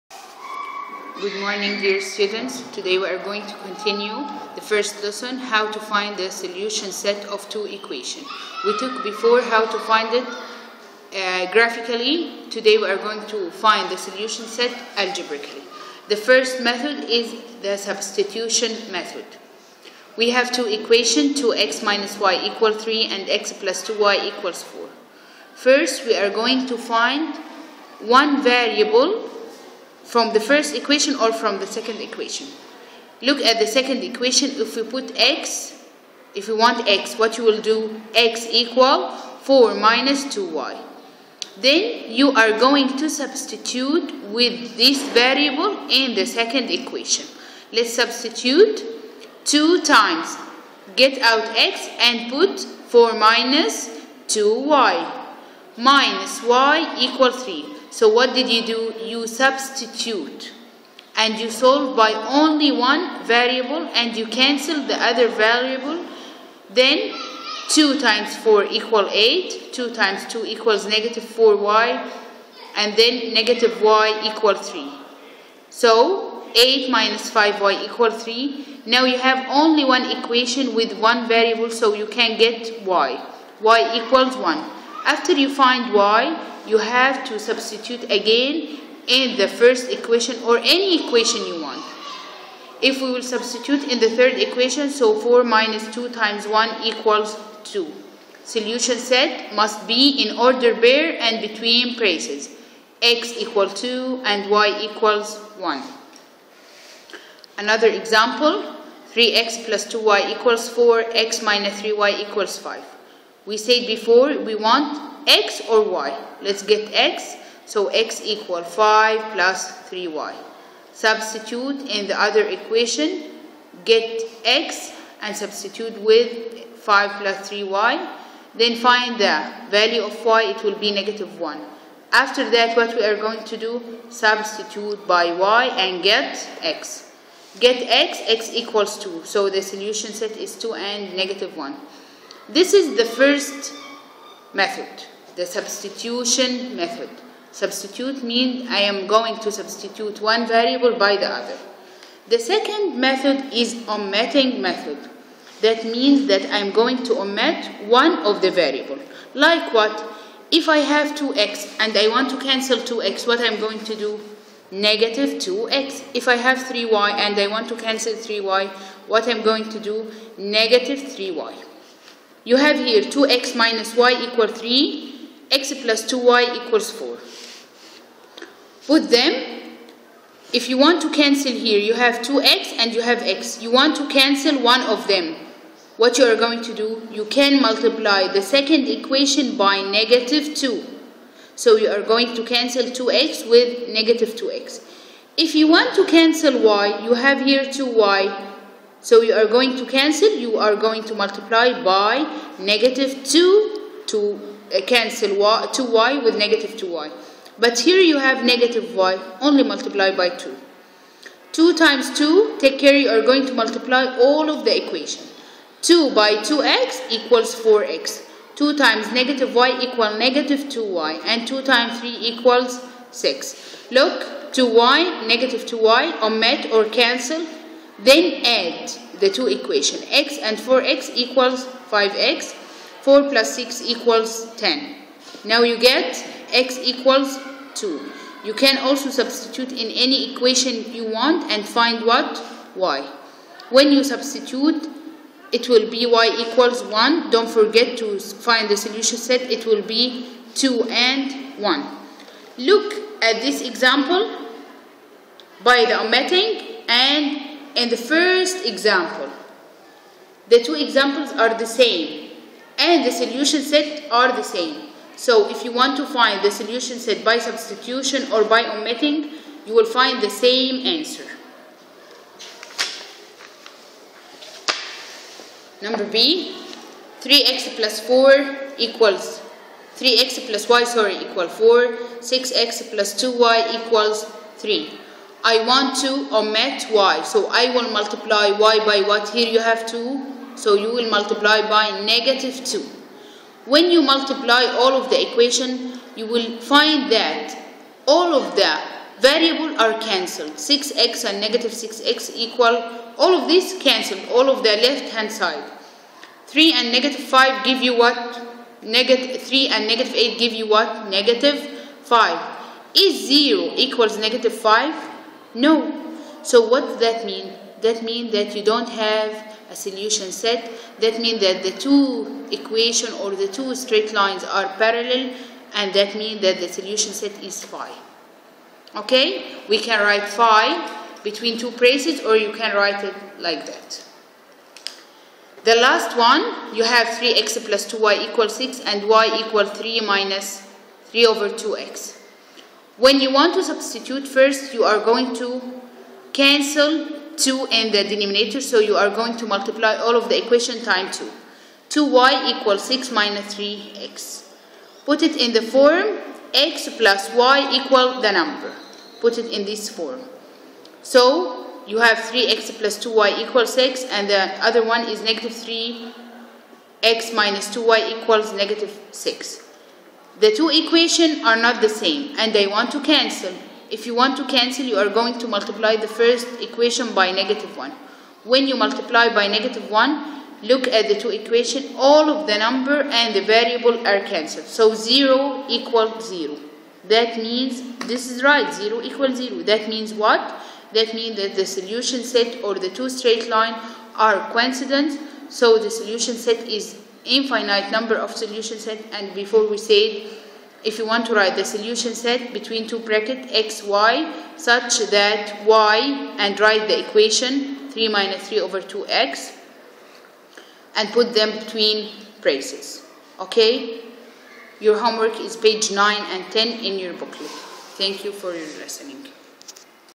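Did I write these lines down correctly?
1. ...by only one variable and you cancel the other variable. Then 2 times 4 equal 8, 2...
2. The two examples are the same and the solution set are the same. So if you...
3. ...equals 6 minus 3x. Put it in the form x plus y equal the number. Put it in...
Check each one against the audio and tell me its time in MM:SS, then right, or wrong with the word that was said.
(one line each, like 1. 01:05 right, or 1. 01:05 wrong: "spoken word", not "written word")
1. 01:01 right
2. 04:20 right
3. 05:52 right.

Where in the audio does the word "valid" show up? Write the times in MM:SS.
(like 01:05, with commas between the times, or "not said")
not said.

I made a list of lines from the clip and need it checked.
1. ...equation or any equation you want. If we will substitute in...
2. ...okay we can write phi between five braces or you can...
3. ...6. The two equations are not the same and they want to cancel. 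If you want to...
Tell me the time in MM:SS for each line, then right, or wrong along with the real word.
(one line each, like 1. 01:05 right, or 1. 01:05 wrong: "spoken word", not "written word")
1. 01:29 right
2. 05:28 wrong: "two", not "five"
3. 06:09 right.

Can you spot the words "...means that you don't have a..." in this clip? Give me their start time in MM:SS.
05:18.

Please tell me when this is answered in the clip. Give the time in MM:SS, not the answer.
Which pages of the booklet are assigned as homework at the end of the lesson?
06:55.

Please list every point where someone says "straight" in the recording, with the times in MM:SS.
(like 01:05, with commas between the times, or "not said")
05:23, 06:33.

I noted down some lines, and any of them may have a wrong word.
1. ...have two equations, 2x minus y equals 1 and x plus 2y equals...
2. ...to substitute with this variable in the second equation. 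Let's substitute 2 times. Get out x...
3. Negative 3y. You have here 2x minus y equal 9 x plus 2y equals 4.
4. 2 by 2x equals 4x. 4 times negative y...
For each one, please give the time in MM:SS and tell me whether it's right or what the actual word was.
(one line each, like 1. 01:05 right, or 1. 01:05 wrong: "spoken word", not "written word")
1. 00:20 wrong: "3", not "1"
2. 00:42 right
3. 02:50 wrong: "3", not "9"
4. 03:35 wrong: "2", not "4".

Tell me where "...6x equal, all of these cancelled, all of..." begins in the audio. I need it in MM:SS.
05:01.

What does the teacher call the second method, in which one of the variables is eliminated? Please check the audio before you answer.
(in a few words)
omitting method.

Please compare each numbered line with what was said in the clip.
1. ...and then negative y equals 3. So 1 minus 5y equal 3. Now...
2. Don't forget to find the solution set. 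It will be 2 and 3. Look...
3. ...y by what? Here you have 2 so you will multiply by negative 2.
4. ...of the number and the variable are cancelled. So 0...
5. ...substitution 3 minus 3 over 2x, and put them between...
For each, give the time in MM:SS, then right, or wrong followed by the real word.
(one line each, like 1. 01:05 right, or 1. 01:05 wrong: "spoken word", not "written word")
1. 01:12 wrong: "8", not "1"
2. 04:07 wrong: "1", not "3"
3. 04:48 right
4. 06:22 right
5. 06:47 wrong: "equation", not "substitution".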